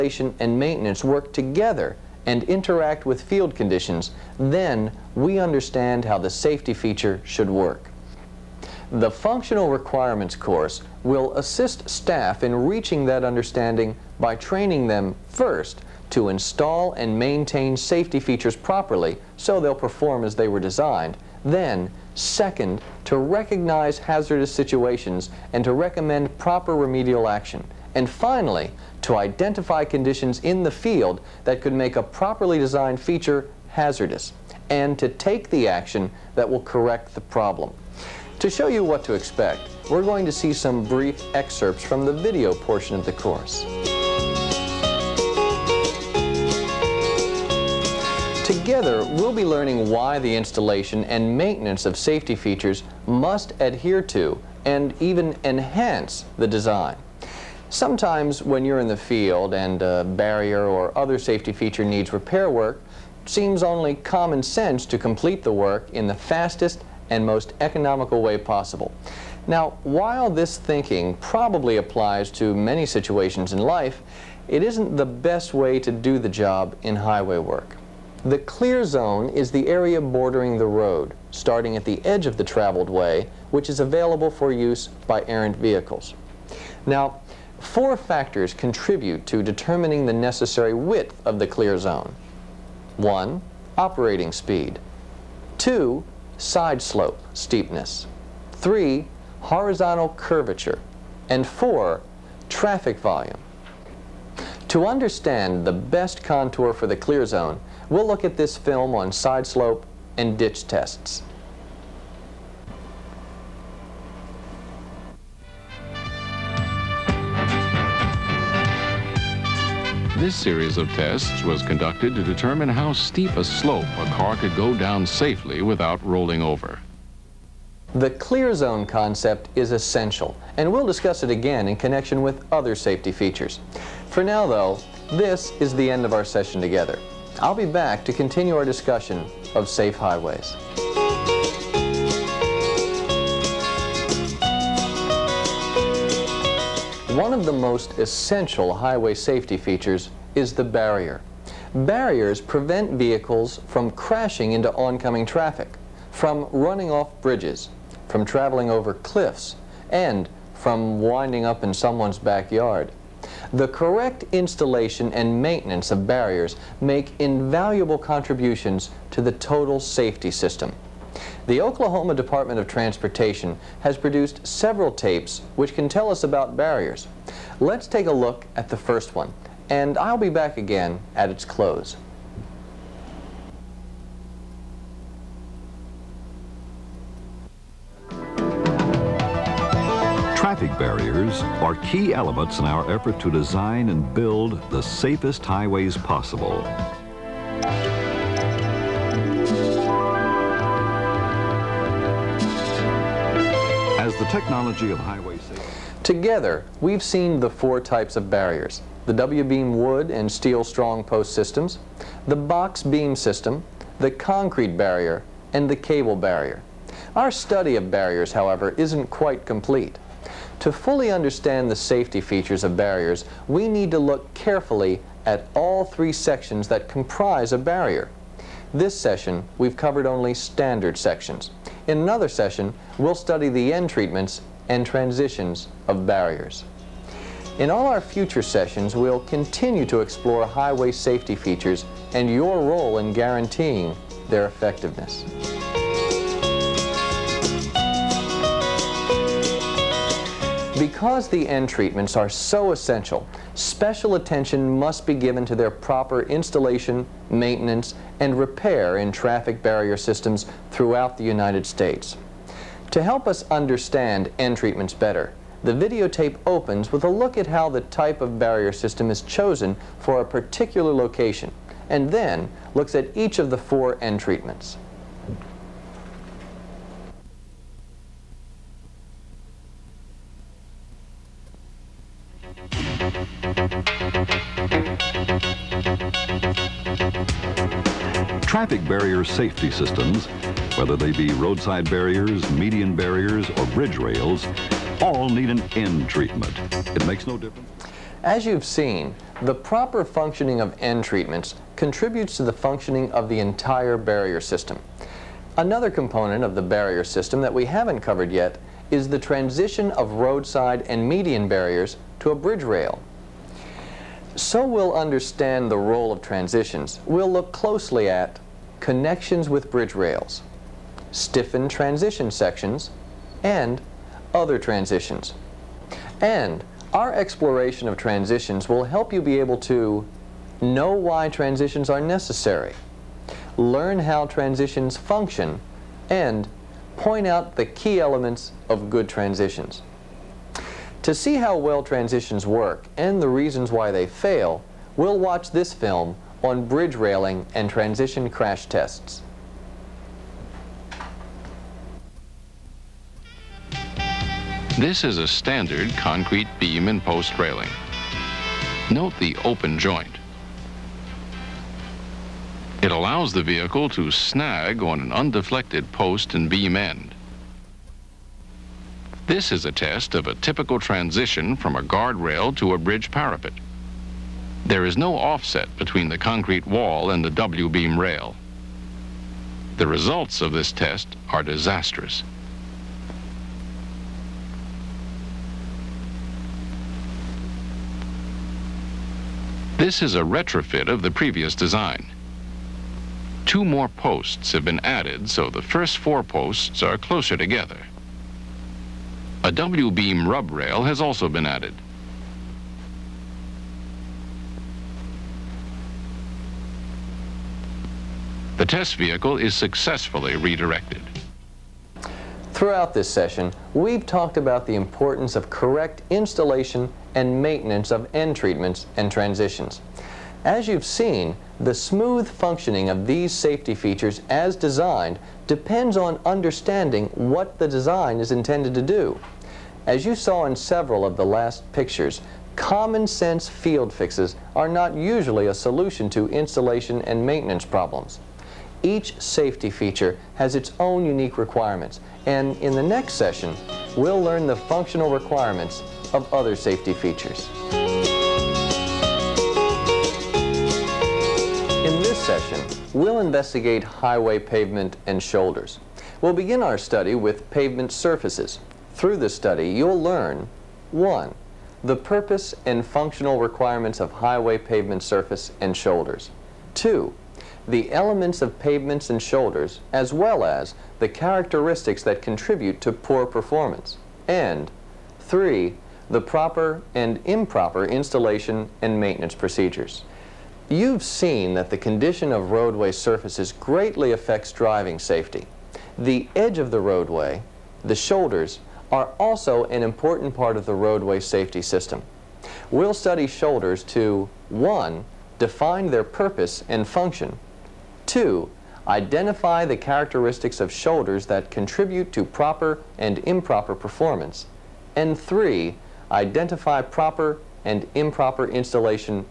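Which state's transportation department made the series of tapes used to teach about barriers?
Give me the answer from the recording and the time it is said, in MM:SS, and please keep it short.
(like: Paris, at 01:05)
Oklahoma, at 02:51.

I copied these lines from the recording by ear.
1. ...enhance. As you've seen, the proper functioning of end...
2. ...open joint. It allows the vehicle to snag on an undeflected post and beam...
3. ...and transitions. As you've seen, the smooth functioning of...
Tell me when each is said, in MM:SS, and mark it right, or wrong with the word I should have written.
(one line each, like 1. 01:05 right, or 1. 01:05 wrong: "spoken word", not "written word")
1. 04:57 wrong: "difference", not "enhance"
2. 05:59 right
3. 06:58 right.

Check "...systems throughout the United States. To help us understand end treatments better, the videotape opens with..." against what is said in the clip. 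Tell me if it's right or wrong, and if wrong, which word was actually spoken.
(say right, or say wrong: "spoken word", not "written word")
right.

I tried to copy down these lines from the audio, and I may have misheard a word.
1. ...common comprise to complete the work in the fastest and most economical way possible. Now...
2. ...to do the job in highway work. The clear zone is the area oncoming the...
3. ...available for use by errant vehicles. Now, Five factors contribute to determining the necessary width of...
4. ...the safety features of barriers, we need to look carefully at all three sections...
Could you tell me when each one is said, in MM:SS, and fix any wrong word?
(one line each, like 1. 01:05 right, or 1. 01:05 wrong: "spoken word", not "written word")
1. 01:03 wrong: "sense", not "comprise"
2. 01:15 wrong: "bordering", not "oncoming"
3. 01:23 wrong: "Four", not "Five"
4. 03:41 right.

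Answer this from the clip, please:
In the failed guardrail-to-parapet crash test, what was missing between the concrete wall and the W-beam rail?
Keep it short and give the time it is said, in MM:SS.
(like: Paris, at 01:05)
Offset, at 06:14.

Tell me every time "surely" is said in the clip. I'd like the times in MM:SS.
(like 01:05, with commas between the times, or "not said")
not said.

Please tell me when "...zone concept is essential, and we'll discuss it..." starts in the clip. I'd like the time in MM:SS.
02:08.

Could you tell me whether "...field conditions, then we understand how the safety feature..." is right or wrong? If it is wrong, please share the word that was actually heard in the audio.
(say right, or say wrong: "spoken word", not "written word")
right.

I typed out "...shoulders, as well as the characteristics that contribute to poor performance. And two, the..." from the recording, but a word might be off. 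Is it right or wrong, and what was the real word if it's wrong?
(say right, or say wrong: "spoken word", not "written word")
wrong: "three", not "two".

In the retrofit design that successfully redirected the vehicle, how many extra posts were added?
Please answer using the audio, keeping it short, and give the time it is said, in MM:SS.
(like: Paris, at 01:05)
2, at 06:33.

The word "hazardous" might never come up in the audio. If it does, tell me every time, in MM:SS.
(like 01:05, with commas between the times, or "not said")
00:23, 00:33.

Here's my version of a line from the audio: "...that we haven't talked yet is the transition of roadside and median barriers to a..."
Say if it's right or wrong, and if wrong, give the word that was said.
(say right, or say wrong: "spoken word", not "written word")
wrong: "covered", not "talked".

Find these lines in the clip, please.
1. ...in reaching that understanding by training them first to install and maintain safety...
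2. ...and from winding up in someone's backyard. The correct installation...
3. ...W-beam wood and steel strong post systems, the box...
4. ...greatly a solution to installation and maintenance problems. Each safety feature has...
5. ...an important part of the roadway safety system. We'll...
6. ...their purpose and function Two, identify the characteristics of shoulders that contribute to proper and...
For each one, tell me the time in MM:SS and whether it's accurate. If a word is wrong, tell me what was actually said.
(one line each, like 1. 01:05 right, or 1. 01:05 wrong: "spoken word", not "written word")
1. 00:12 right
2. 02:39 right
3. 03:29 right
4. 07:14 wrong: "usually", not "greatly"
5. 08:09 right
6. 08:15 right.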